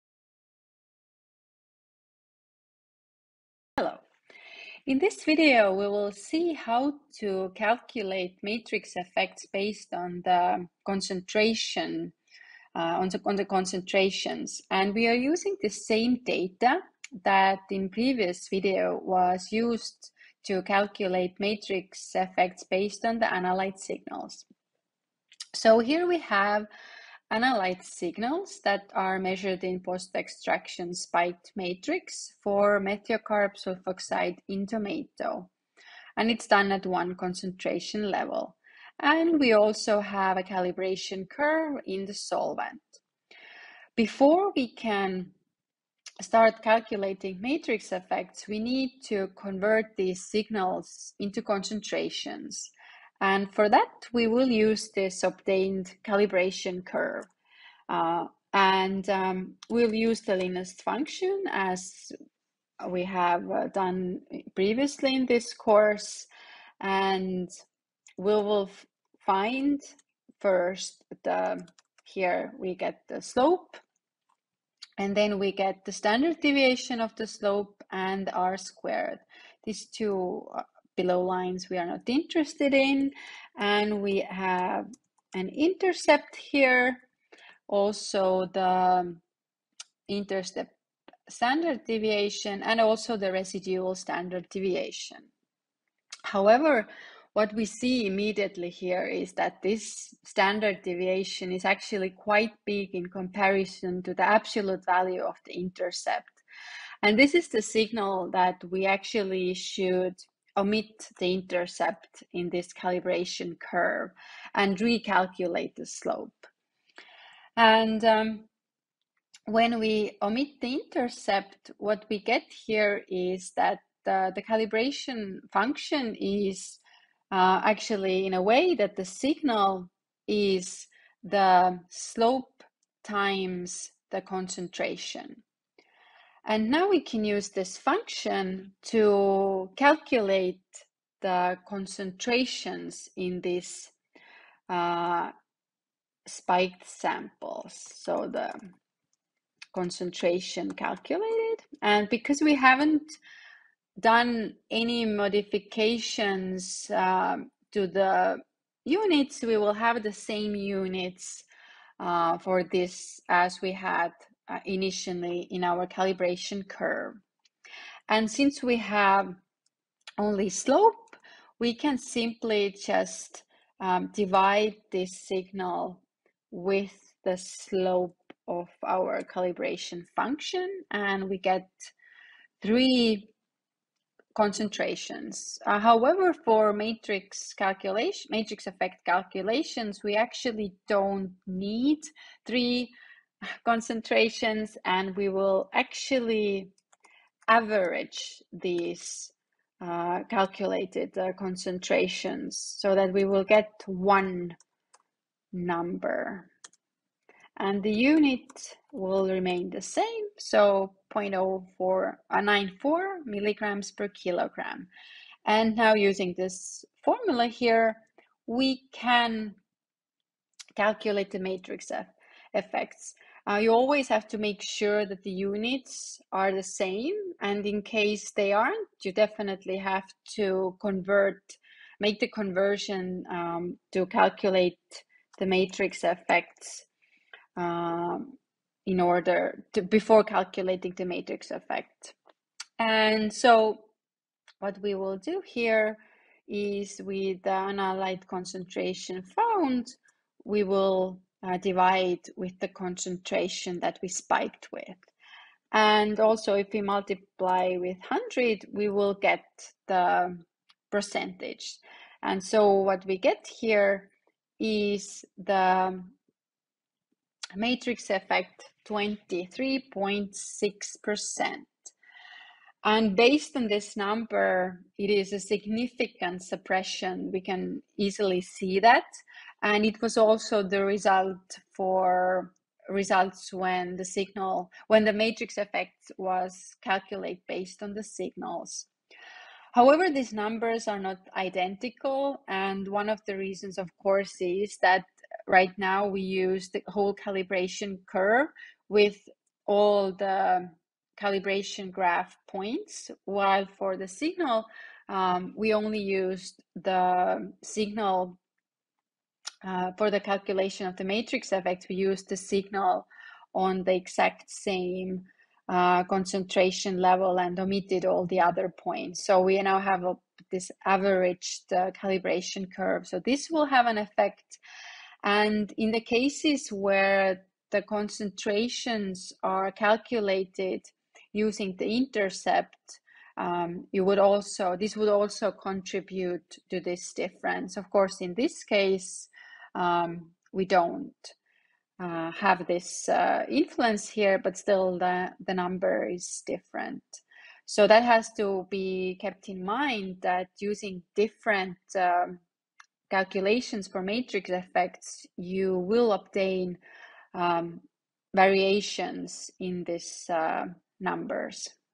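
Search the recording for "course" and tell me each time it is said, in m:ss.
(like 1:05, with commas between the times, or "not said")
1:05, 4:54, 5:37.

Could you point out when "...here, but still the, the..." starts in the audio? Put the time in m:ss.
5:44.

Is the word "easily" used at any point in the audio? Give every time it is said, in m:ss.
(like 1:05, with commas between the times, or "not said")
4:37.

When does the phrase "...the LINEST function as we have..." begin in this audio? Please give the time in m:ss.
1:00.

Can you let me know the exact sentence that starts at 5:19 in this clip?
So we now have a, this averaged uh, calibration curve.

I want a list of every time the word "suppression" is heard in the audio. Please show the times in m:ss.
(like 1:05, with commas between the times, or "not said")
4:36.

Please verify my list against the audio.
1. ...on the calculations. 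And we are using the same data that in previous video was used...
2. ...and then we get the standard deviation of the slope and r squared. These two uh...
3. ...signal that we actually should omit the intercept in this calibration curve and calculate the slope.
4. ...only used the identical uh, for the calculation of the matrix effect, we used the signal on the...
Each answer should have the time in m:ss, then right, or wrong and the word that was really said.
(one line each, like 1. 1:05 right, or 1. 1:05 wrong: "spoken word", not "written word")
1. 0:13 wrong: "concentrations", not "calculations"
2. 1:14 right
3. 1:47 wrong: "recalculate", not "calculate"
4. 5:05 wrong: "signal", not "identical".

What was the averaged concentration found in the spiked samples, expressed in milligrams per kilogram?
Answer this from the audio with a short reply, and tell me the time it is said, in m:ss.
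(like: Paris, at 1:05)
0.0494, at 3:31.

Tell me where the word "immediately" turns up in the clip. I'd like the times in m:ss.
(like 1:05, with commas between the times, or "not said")
1:38.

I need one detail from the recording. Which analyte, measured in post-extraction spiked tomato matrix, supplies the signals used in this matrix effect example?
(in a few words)
methiocarb sulfoxide.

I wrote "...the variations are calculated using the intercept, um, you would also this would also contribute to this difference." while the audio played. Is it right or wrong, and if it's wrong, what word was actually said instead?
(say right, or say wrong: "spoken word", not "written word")
wrong: "concentrations", not "variations".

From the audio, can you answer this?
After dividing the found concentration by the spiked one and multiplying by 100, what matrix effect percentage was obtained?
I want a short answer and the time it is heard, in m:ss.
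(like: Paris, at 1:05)
23.6%, at 4:28.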